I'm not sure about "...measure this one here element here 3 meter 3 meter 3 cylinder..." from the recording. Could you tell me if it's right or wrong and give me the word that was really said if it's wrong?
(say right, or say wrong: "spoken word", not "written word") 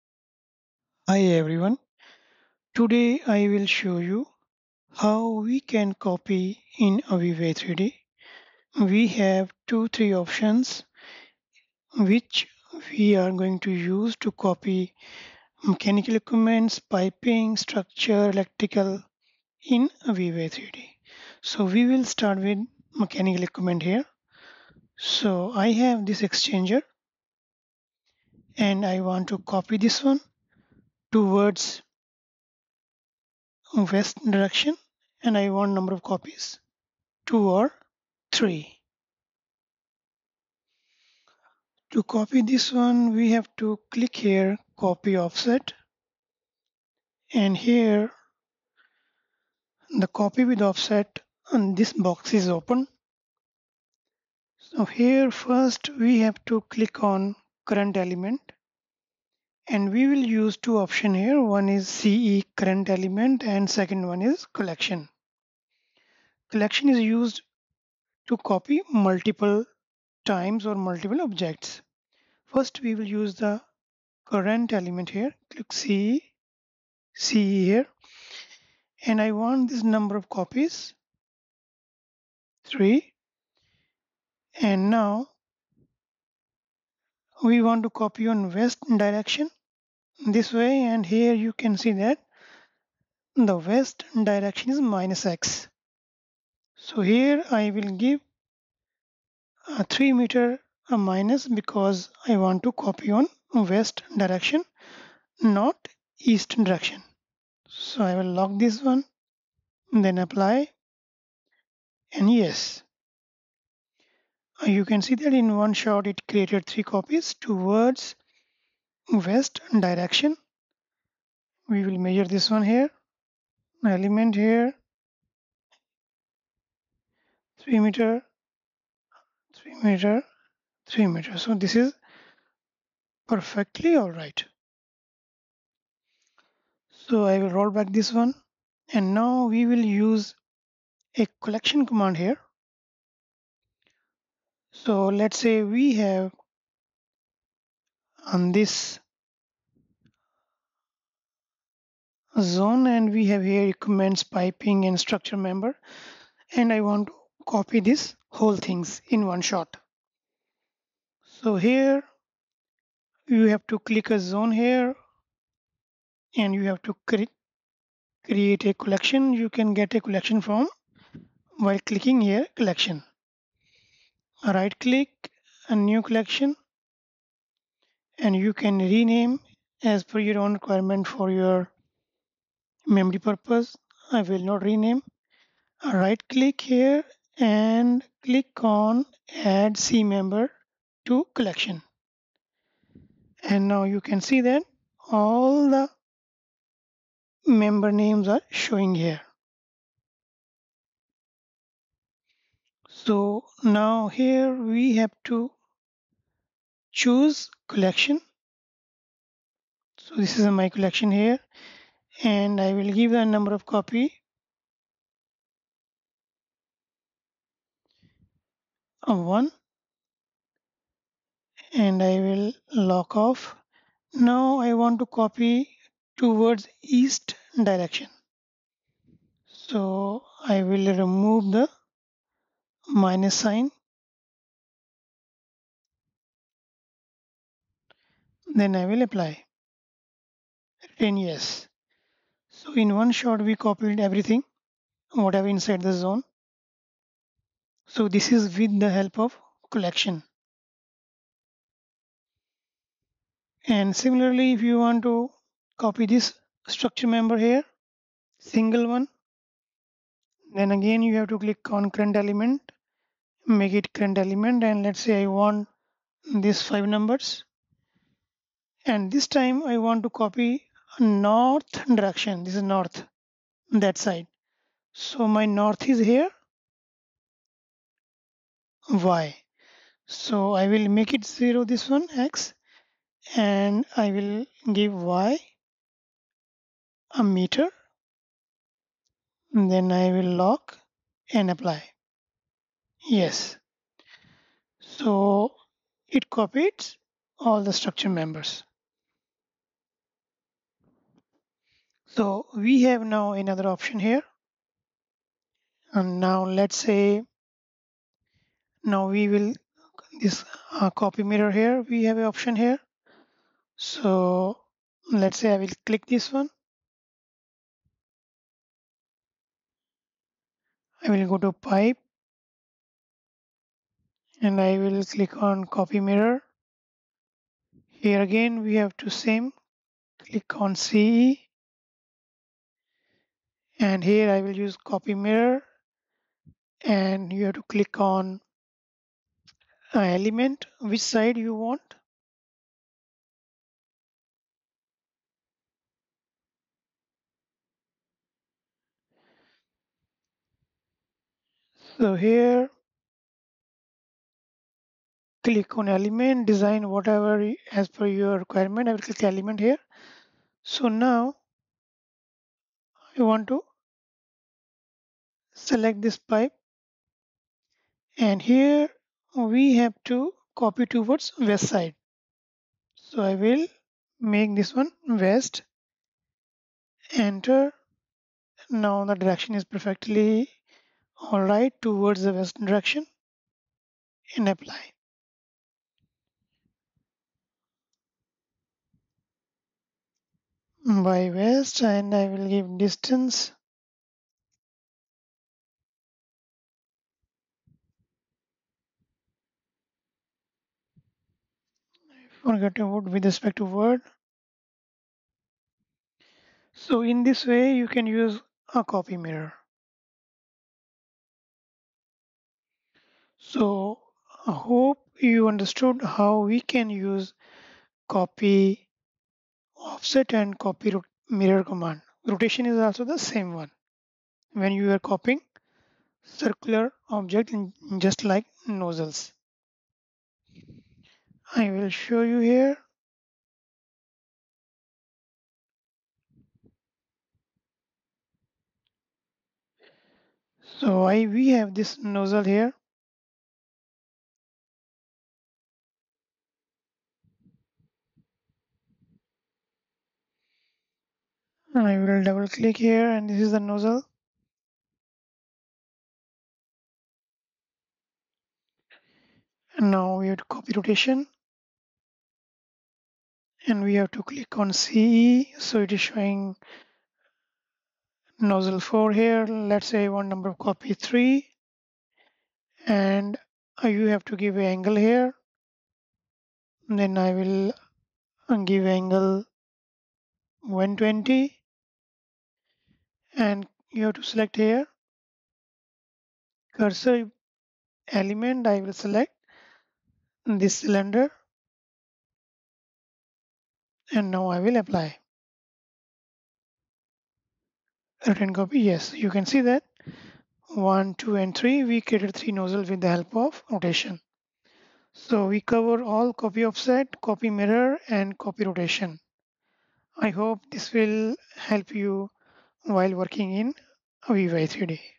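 wrong: "meter", not "cylinder".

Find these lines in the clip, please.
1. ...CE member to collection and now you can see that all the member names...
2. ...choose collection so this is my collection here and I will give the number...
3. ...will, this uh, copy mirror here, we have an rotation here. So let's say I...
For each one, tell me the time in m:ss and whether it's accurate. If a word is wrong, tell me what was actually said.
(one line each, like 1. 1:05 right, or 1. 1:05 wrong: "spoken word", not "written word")
1. 3:09 right
2. 3:26 right
3. 5:09 wrong: "option", not "rotation".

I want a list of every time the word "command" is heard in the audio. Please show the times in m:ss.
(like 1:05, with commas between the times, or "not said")
2:21, 7:01.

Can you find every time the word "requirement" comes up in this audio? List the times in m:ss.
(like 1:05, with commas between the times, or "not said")
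3:00, 5:58.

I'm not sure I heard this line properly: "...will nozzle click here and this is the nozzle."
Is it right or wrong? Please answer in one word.
wrong.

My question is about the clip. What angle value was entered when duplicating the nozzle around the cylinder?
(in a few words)
120.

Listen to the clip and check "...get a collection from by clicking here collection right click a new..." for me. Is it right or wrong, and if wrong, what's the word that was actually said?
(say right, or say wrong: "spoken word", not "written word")
right.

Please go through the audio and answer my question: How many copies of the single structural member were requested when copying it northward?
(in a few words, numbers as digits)
five.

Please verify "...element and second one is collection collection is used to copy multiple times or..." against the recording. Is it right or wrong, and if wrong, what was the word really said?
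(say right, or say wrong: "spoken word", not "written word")
right.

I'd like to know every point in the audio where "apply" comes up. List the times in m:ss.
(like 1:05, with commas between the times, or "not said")
1:50, 3:59, 4:51, 6:24, 8:14.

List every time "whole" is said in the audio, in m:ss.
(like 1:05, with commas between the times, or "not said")
2:38.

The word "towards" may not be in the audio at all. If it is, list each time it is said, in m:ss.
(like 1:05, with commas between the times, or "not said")
0:31, 3:46, 6:10, 6:21.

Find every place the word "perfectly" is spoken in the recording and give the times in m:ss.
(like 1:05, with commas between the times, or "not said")
2:13, 6:19.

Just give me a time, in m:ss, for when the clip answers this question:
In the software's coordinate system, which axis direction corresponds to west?
1:34.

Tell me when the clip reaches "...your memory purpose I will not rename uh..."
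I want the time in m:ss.
3:01.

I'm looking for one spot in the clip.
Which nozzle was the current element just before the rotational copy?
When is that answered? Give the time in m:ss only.
7:48.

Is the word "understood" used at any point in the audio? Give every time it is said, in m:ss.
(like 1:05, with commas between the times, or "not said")
6:55.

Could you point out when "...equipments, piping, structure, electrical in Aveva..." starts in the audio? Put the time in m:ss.
0:16.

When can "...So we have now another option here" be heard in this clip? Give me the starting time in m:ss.
5:02.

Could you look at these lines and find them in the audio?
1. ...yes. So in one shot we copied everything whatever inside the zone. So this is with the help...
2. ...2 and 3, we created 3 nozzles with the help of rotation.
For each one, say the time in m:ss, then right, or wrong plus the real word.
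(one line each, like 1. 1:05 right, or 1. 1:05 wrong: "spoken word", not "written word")
1. 4:01 right
2. 8:21 right.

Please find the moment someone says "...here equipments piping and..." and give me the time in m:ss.
2:33.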